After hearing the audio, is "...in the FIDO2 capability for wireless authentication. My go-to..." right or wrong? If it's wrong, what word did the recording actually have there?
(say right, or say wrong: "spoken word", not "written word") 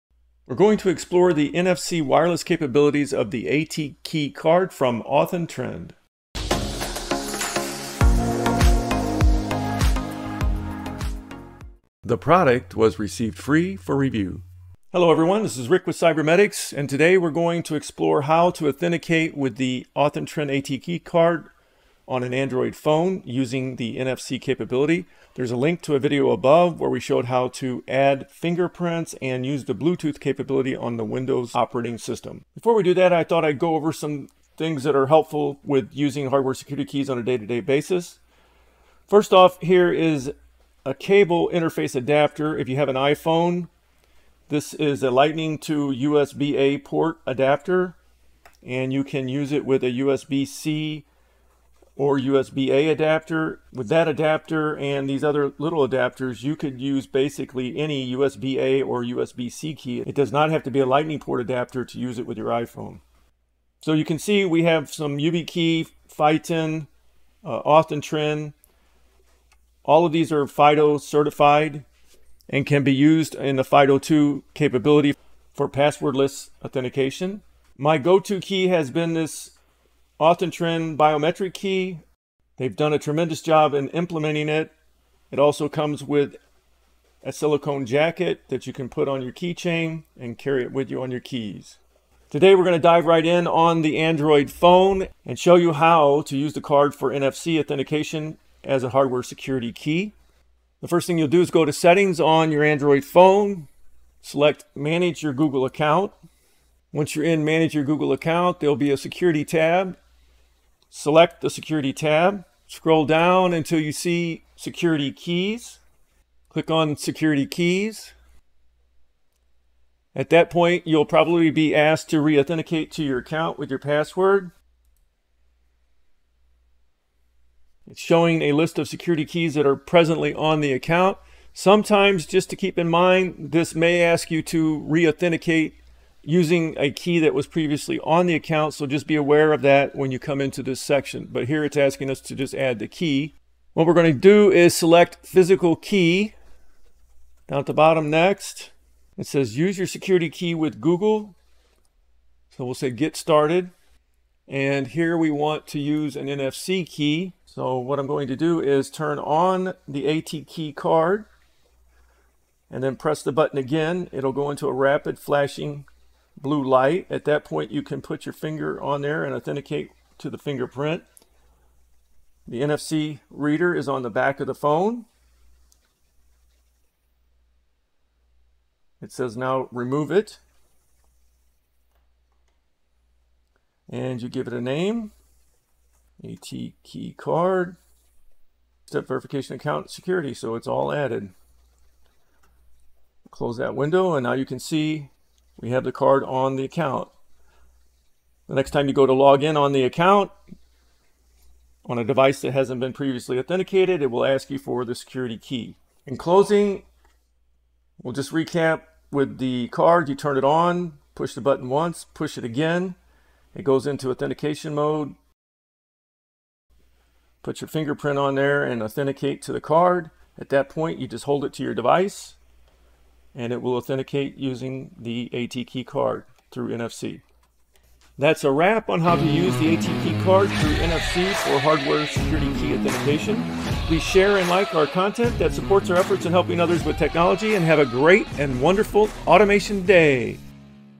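wrong: "passwordless", not "wireless".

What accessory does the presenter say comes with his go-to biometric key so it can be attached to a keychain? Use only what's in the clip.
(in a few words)
silicone jacket.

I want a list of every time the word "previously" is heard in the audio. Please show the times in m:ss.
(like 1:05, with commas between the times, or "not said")
2:17, 3:22.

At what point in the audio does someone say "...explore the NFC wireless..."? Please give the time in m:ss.
0:00.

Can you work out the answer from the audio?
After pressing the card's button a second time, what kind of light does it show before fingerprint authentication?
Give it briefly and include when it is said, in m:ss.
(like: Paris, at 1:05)
rapid flashing blue light, at 2:44.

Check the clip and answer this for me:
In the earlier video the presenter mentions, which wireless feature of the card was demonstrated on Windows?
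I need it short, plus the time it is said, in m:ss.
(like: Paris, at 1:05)
Bluetooth, at 0:29.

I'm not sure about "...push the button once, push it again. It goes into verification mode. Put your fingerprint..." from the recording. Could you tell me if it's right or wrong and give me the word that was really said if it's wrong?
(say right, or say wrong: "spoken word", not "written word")
wrong: "authentication", not "verification".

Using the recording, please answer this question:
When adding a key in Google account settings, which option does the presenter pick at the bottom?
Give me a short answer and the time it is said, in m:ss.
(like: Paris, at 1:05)
physical key, at 2:25.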